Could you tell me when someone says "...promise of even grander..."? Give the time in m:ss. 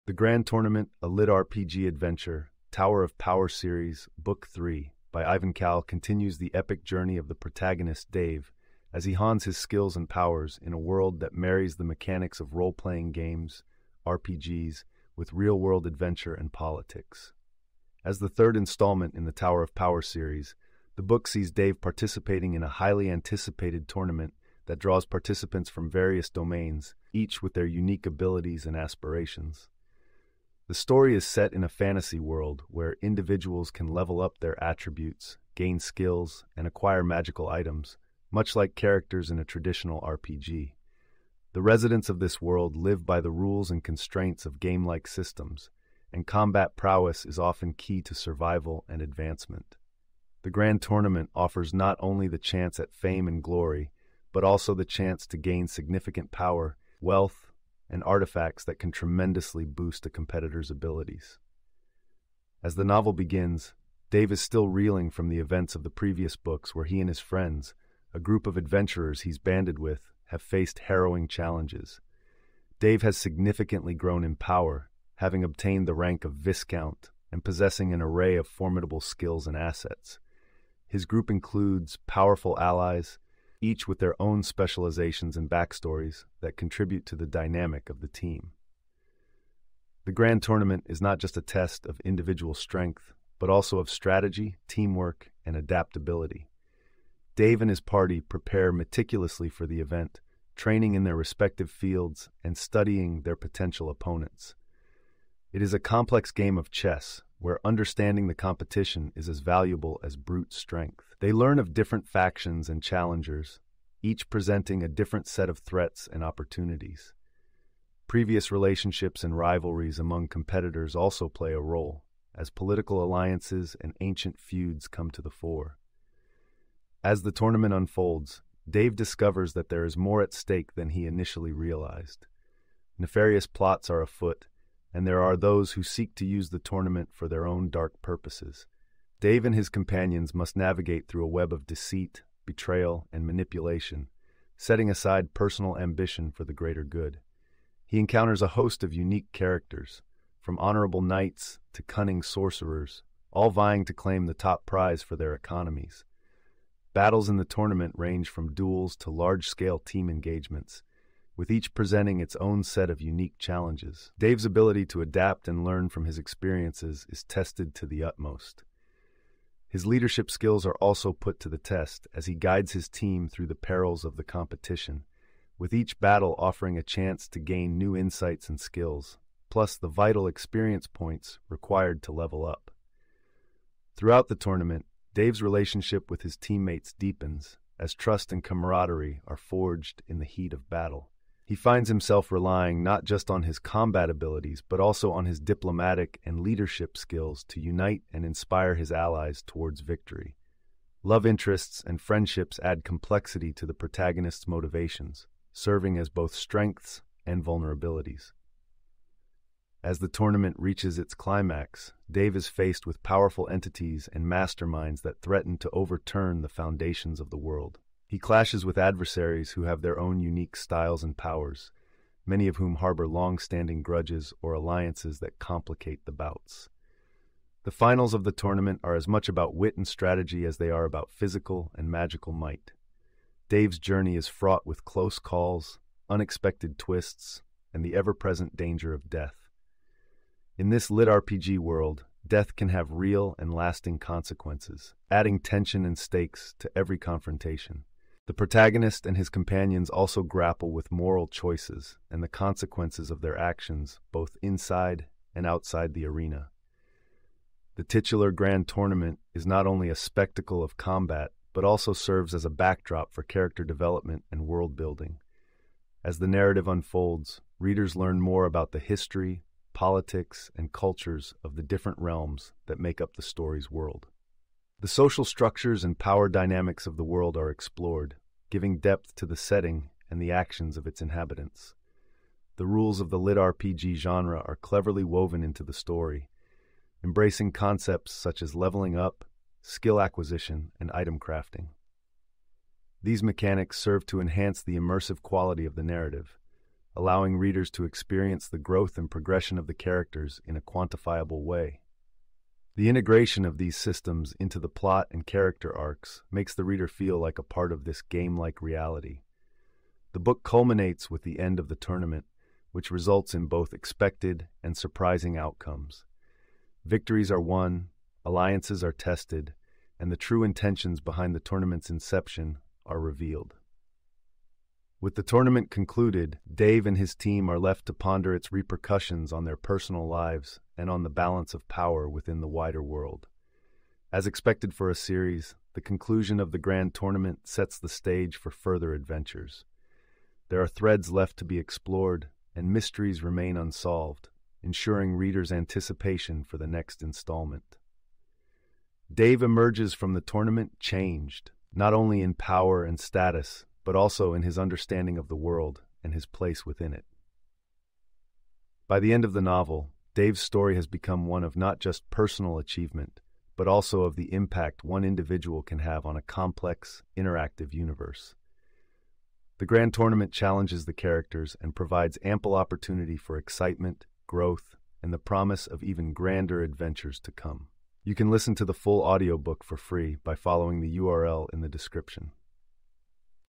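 6:15.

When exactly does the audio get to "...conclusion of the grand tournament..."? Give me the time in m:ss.
5:35.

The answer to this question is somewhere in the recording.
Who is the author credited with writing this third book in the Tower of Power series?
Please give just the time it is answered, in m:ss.
0:05.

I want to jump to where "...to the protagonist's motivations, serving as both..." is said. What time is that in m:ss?
3:23.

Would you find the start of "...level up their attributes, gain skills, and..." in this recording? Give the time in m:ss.
0:33.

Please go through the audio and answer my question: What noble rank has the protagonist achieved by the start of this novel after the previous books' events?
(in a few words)
Viscount.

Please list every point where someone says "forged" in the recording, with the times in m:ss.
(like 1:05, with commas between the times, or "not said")
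3:09.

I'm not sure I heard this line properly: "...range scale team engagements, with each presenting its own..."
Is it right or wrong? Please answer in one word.
wrong.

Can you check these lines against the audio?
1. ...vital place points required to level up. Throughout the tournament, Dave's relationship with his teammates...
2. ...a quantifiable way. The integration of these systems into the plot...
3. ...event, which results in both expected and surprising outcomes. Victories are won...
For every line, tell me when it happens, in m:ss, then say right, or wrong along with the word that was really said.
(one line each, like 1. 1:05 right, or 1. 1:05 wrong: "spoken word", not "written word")
1. 2:59 wrong: "experience", not "place"
2. 5:00 right
3. 5:11 wrong: "tournament", not "event".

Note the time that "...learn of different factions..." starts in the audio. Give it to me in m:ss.
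1:51.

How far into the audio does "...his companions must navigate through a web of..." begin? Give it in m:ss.
2:19.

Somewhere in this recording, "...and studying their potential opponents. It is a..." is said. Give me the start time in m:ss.
1:42.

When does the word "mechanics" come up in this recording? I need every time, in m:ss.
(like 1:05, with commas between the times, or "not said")
0:11, 4:53.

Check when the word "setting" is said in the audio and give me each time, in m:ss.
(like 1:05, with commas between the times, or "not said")
2:24, 4:39.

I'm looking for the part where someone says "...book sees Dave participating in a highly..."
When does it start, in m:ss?
0:21.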